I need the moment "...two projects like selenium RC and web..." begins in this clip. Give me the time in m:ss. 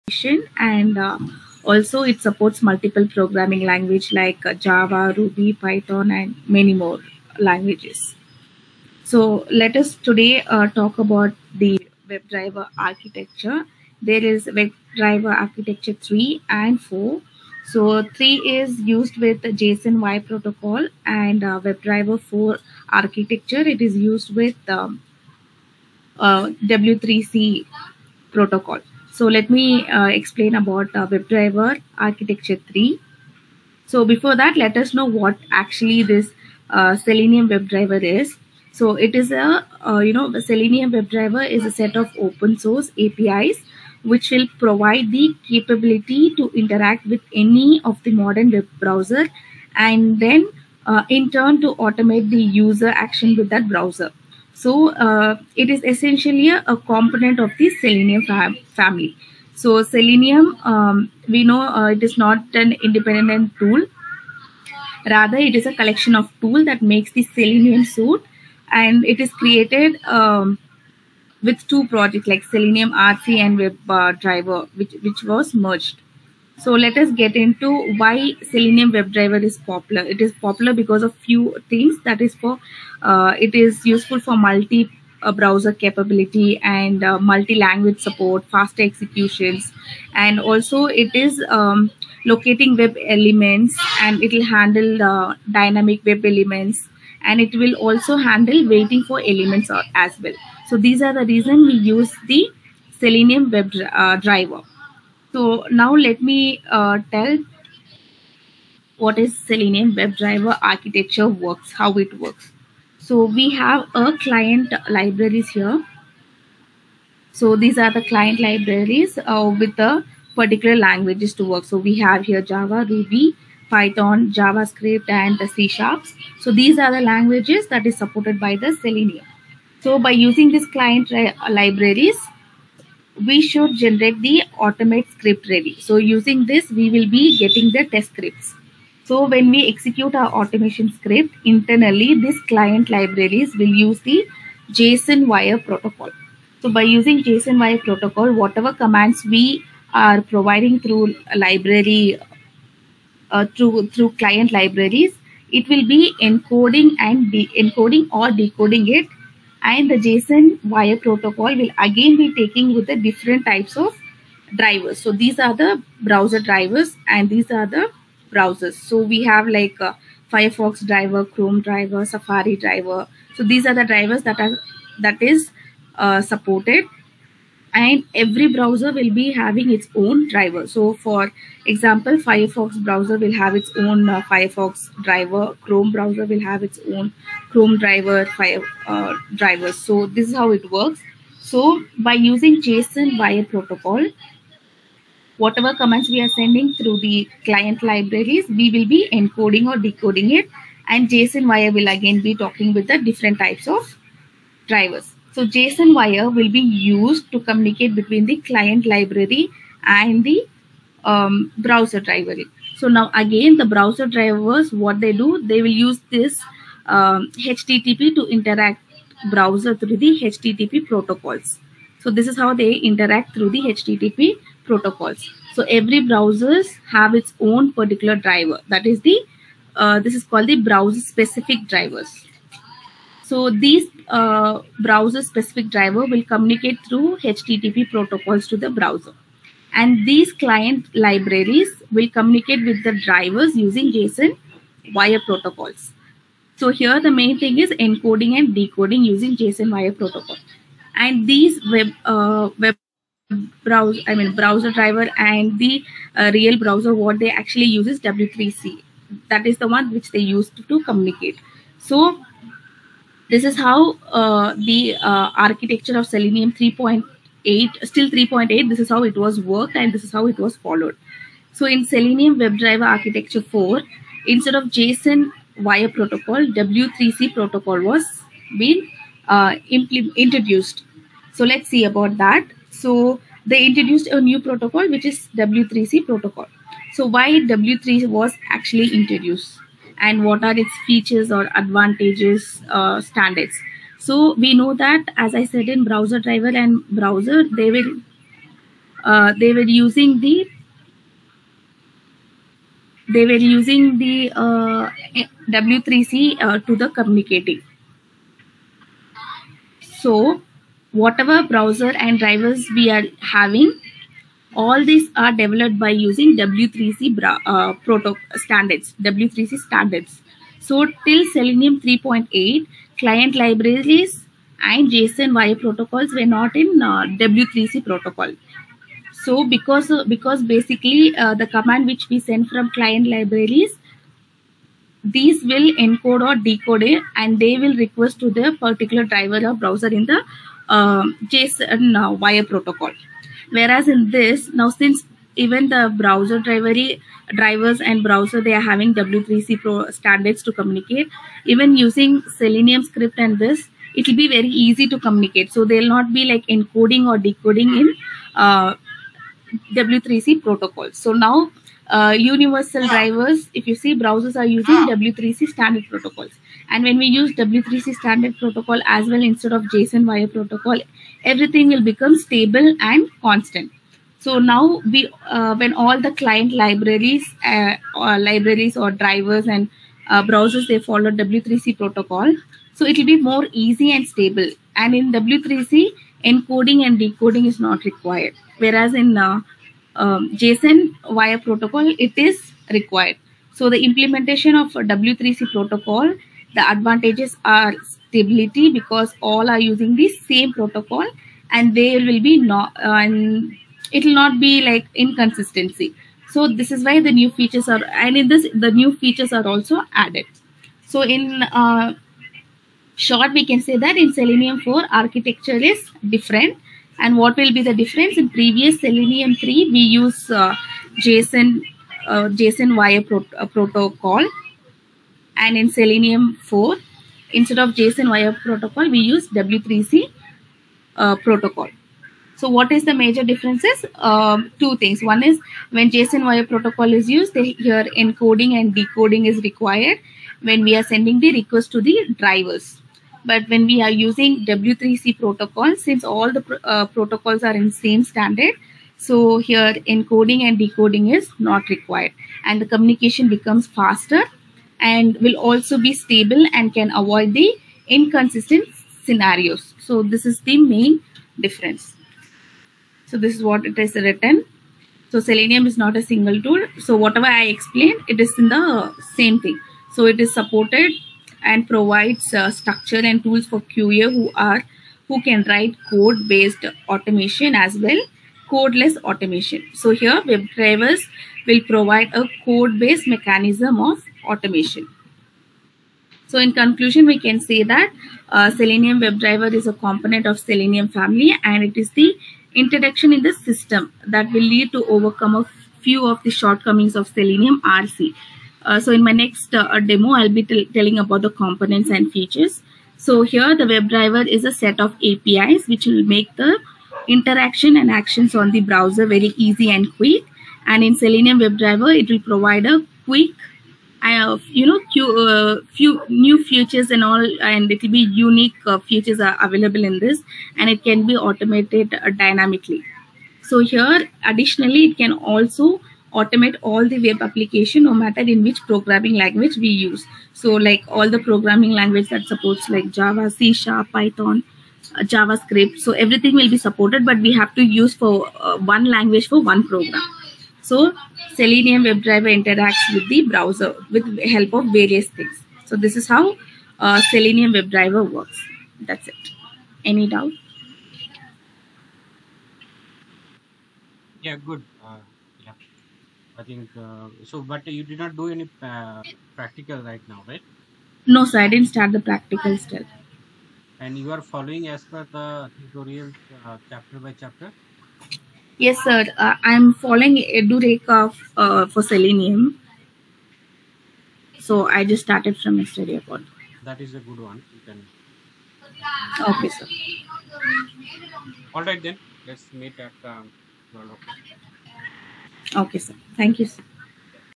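1:11.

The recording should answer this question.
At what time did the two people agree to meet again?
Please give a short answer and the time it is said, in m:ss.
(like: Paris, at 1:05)
12 o'clock, at 9:43.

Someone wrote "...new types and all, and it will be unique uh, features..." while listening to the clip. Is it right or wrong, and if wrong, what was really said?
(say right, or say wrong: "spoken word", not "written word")
wrong: "features", not "types".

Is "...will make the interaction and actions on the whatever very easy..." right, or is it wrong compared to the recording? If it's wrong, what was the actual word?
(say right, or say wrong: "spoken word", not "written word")
wrong: "browser", not "whatever".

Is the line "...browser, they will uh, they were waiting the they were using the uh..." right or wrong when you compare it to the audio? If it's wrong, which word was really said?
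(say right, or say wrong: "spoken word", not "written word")
wrong: "using", not "waiting".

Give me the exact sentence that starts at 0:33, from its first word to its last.
So before that, let us know what actually this uh, Selenium WebDriver is.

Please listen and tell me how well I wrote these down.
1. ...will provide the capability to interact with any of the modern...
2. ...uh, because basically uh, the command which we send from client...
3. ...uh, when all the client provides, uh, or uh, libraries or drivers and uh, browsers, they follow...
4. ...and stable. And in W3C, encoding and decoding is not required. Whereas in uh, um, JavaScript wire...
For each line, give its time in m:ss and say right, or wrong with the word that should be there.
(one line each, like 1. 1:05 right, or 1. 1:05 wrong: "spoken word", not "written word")
1. 0:44 right
2. 5:29 right
3. 6:15 wrong: "libraries", not "provides"
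4. 6:23 wrong: "JSON", not "JavaScript".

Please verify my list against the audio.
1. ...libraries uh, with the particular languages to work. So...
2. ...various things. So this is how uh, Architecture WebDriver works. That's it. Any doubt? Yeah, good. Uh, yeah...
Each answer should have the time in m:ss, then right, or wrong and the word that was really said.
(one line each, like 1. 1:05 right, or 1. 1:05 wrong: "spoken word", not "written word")
1. 1:58 right
2. 9:04 wrong: "Selenium", not "Architecture".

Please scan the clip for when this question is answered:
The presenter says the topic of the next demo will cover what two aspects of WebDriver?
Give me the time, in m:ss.
8:21.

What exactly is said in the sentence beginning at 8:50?
So like all the programming language that supports like Java, C Sharp, Python, uh, JavaScript.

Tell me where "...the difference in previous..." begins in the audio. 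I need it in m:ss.
6:57.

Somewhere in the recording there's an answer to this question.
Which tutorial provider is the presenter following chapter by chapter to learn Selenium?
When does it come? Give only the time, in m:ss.
9:30.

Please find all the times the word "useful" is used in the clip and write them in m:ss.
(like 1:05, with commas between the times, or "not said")
1:23.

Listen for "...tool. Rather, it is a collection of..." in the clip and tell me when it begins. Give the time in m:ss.
1:03.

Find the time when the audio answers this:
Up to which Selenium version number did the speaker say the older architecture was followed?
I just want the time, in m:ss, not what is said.
4:27.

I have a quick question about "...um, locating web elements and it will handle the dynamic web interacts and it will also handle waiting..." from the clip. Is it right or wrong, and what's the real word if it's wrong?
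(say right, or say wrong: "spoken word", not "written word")
wrong: "elements", not "interacts".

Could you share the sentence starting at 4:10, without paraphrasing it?
And these web, uh, web browser, I mean browser driver and the uh, real browser, what they actually use is W3C.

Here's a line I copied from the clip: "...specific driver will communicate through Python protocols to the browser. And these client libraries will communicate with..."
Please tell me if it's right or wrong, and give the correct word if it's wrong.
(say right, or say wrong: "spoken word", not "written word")
wrong: "HTTP", not "Python".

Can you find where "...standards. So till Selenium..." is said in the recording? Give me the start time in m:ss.
5:19.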